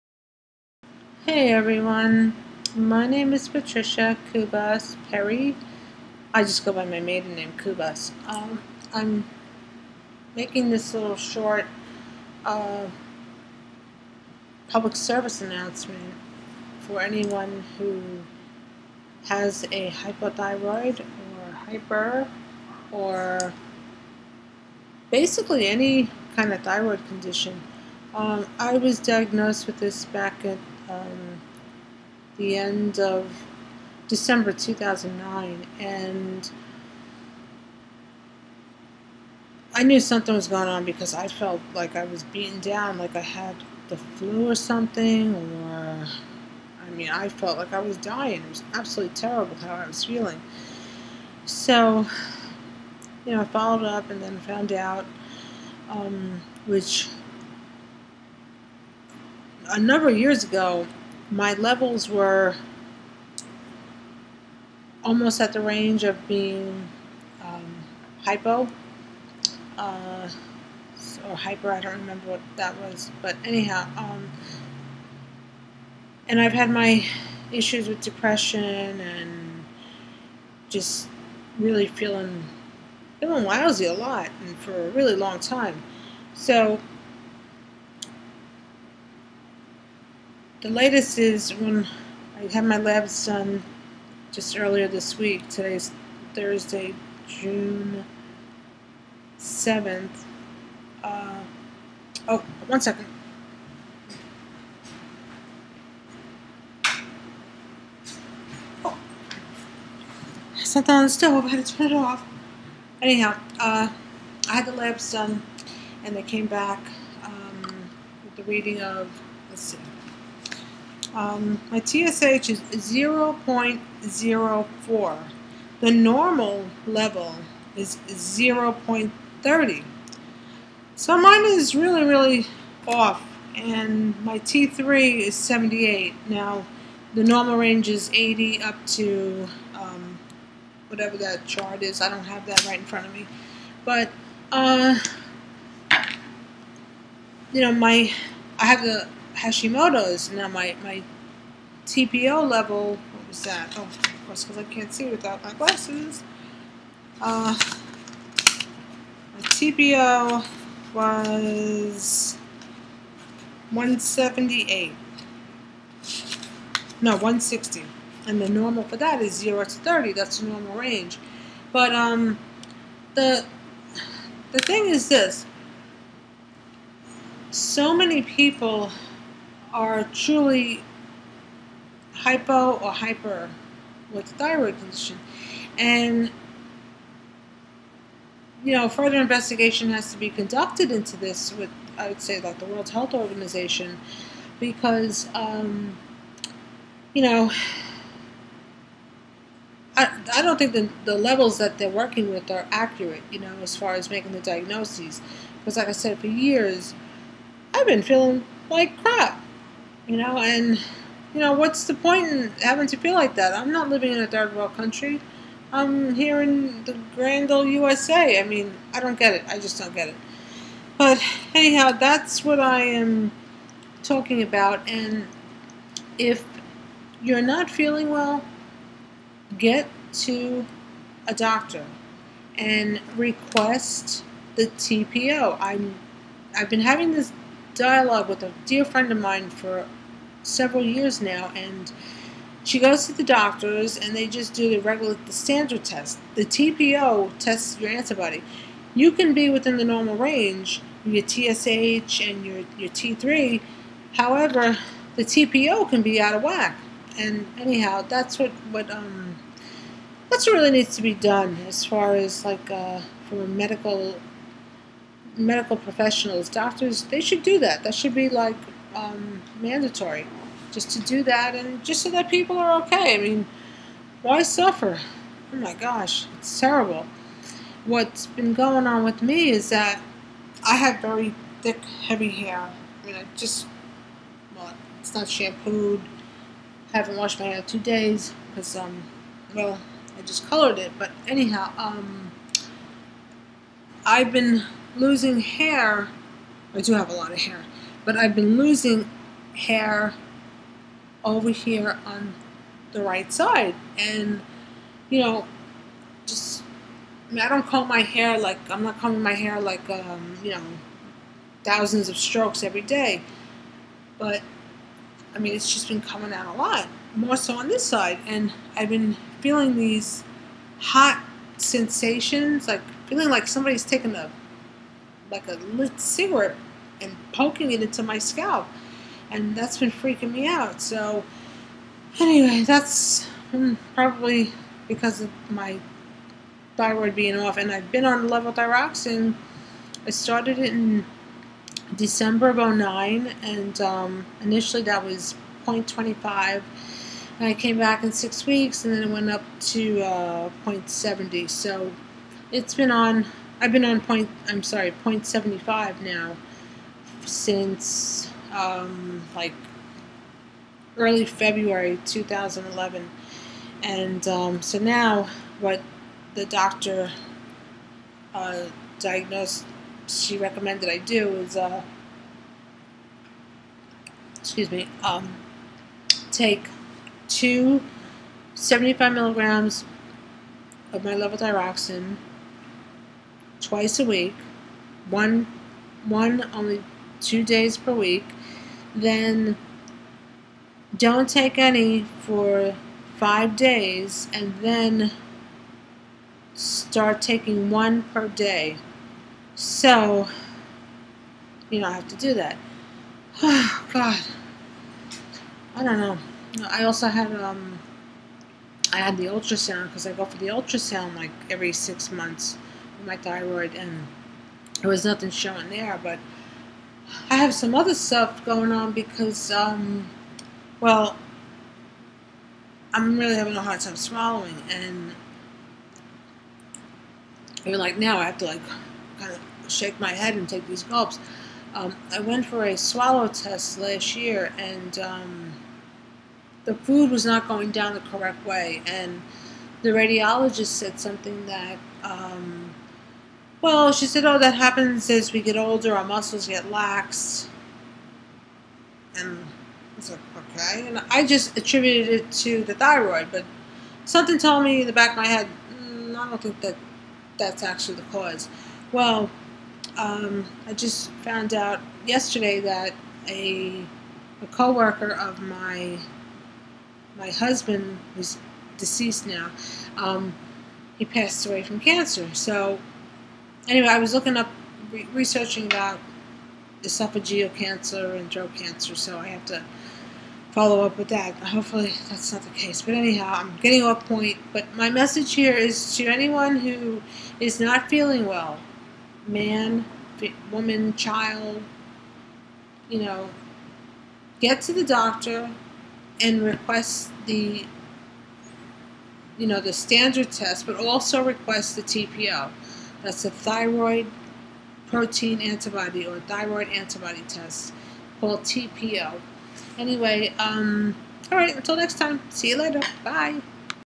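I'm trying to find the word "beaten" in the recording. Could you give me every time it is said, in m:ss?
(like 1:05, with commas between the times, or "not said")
0:42.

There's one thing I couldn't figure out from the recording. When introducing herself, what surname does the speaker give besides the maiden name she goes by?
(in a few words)
Perry.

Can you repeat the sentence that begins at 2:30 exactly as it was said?
Now my, my TPO level, what was that?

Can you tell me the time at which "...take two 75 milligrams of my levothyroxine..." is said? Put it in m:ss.
6:16.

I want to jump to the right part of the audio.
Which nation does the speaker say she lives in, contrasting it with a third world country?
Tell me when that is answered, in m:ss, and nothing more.
3:37.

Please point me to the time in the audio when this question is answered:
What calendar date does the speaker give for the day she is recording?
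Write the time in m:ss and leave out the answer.
1:37.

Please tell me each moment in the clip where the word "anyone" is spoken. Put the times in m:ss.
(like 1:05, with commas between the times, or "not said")
0:16, 8:06.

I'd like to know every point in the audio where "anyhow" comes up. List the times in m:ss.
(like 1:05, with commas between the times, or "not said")
1:13, 1:53, 3:41, 4:17, 4:51, 8:02.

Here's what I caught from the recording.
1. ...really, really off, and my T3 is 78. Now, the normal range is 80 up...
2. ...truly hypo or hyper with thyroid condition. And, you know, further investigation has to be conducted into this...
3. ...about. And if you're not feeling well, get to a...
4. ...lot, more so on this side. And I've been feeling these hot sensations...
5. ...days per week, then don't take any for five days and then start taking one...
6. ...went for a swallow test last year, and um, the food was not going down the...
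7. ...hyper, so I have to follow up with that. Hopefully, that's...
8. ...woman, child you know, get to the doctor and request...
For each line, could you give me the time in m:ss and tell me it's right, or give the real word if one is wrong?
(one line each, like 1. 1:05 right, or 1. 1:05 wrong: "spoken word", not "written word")
1. 2:11 right
2. 3:00 right
3. 3:44 right
4. 5:16 right
5. 6:27 right
6. 7:12 right
7. 7:58 wrong: "cancer", not "hyper"
8. 8:10 right.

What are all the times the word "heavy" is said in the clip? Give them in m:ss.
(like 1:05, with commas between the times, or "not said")
4:42.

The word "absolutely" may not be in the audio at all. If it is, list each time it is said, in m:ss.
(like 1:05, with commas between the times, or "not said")
0:48.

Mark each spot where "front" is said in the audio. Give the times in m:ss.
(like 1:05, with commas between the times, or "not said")
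2:22.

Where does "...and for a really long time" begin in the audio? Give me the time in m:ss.
1:24.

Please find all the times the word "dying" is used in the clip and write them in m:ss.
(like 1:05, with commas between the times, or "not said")
0:47.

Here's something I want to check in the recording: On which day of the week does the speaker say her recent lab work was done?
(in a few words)
Thursday.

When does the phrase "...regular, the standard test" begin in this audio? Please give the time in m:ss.
4:04.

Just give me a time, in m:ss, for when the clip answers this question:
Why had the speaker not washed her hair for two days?
4:50.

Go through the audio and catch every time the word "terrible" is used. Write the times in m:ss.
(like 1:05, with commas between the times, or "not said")
0:49, 4:36.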